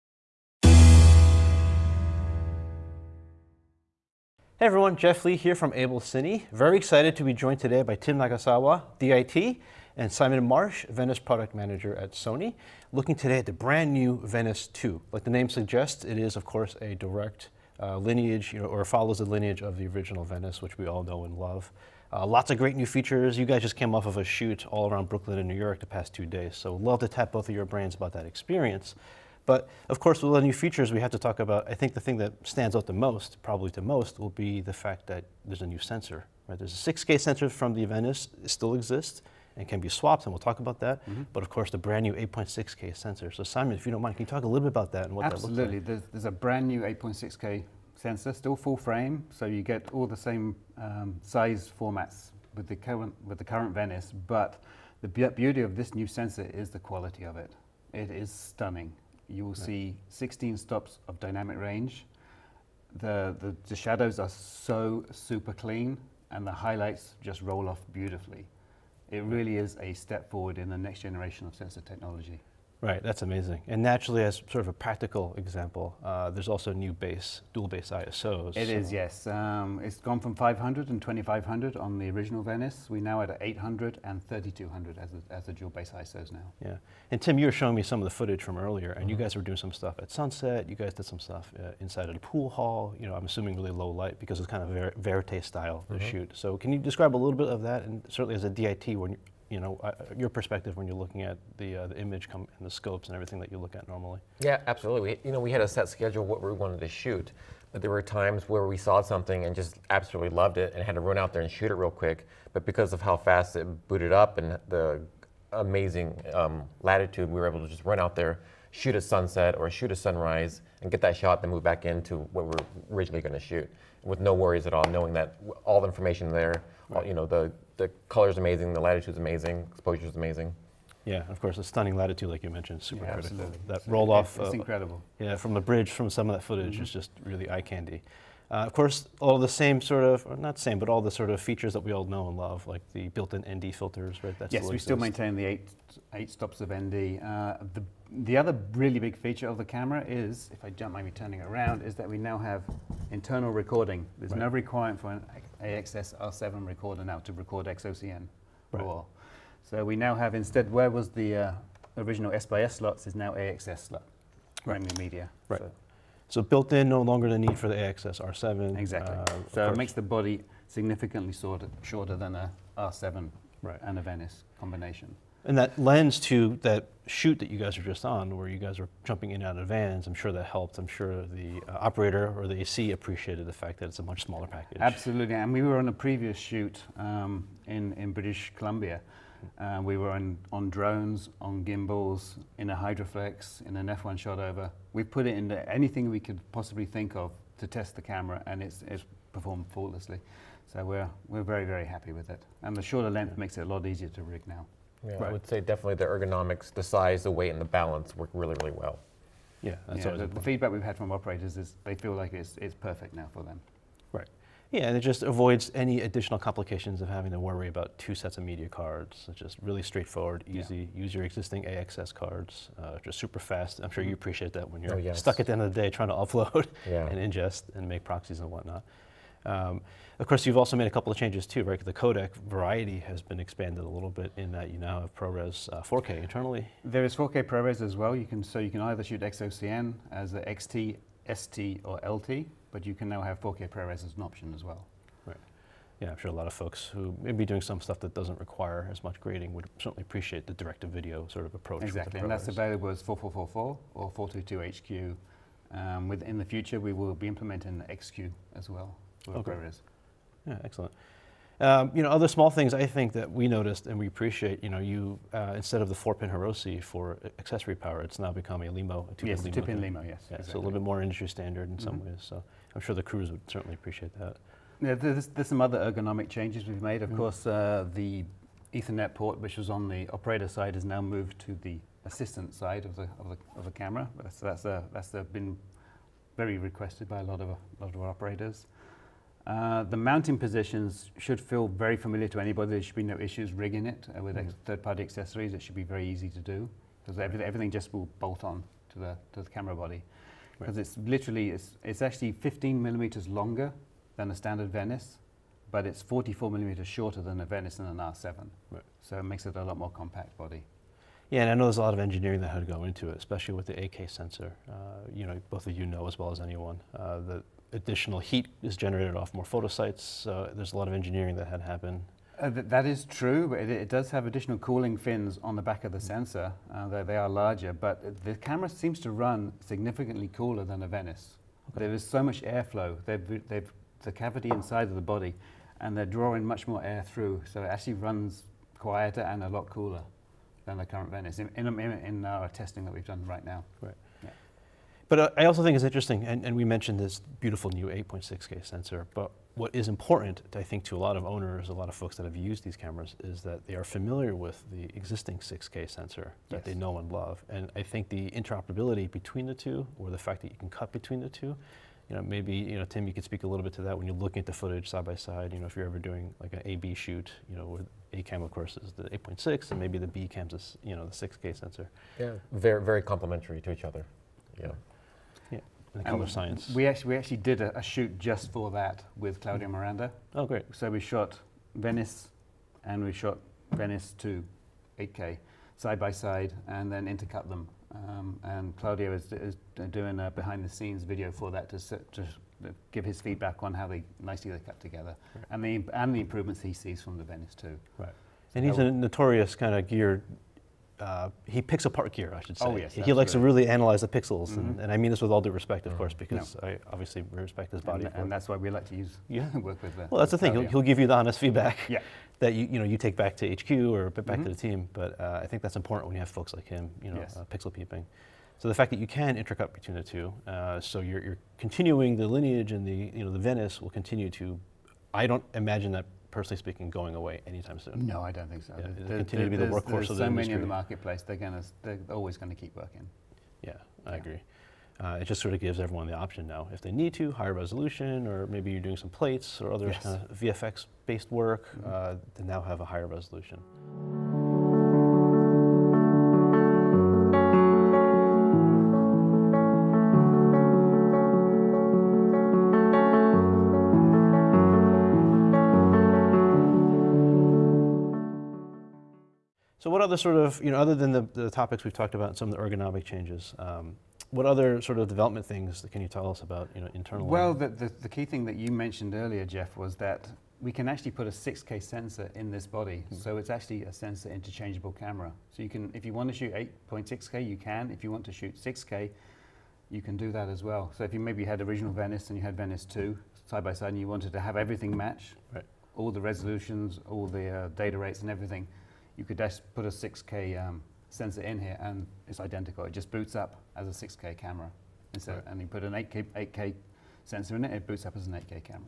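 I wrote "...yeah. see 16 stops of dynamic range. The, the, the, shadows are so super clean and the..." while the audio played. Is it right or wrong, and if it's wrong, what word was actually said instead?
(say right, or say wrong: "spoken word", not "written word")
right.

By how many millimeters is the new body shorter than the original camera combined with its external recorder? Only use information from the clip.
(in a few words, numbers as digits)
44.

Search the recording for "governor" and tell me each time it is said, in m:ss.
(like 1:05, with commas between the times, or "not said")
not said.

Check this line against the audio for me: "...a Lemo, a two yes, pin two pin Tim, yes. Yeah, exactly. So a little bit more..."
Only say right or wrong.
wrong.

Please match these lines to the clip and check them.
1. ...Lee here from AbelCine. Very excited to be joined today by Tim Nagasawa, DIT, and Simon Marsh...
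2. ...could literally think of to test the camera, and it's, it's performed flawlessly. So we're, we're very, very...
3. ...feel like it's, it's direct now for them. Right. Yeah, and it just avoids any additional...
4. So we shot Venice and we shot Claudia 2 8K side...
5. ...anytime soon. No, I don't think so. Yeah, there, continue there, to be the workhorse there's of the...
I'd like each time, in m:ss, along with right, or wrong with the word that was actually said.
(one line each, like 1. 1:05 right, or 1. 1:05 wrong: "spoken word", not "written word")
1. 0:05 right
2. 3:16 wrong: "possibly", not "literally"
3. 3:31 wrong: "perfect", not "direct"
4. 6:20 wrong: "Venice", not "Claudia"
5. 7:07 right.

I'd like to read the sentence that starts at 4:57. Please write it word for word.
everything, everything, just will bolt on to the, to the camera body.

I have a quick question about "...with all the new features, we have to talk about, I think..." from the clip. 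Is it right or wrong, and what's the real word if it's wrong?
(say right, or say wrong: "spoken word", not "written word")
right.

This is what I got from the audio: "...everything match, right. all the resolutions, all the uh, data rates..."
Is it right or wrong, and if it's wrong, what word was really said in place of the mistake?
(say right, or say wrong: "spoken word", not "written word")
right.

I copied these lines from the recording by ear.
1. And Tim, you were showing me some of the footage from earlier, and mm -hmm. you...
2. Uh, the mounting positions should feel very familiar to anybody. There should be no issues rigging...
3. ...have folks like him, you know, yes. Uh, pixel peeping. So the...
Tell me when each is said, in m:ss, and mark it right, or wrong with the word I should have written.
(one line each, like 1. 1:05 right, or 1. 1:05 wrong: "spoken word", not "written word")
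1. 1:27 right
2. 4:49 right
3. 6:56 right.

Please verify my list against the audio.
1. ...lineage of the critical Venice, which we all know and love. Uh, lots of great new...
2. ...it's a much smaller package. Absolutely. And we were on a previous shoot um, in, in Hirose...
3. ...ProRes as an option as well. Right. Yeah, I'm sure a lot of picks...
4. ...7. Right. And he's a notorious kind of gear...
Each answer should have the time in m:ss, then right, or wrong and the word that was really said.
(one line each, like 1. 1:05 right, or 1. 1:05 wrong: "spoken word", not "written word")
1. 0:19 wrong: "original", not "critical"
2. 3:03 wrong: "British", not "Hirose"
3. 4:03 wrong: "folks", not "picks"
4. 6:37 wrong: "2", not "7".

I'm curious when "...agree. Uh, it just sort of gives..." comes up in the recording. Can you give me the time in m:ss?
7:14.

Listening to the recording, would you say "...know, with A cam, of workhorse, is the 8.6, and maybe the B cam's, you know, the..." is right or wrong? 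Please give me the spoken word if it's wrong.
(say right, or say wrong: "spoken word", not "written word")
wrong: "course", not "workhorse".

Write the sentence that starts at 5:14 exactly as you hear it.
Uh, you know, both of you know as well as anyone uh, that additional heat is generated off more photosites.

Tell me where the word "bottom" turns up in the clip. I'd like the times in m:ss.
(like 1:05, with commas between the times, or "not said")
not said.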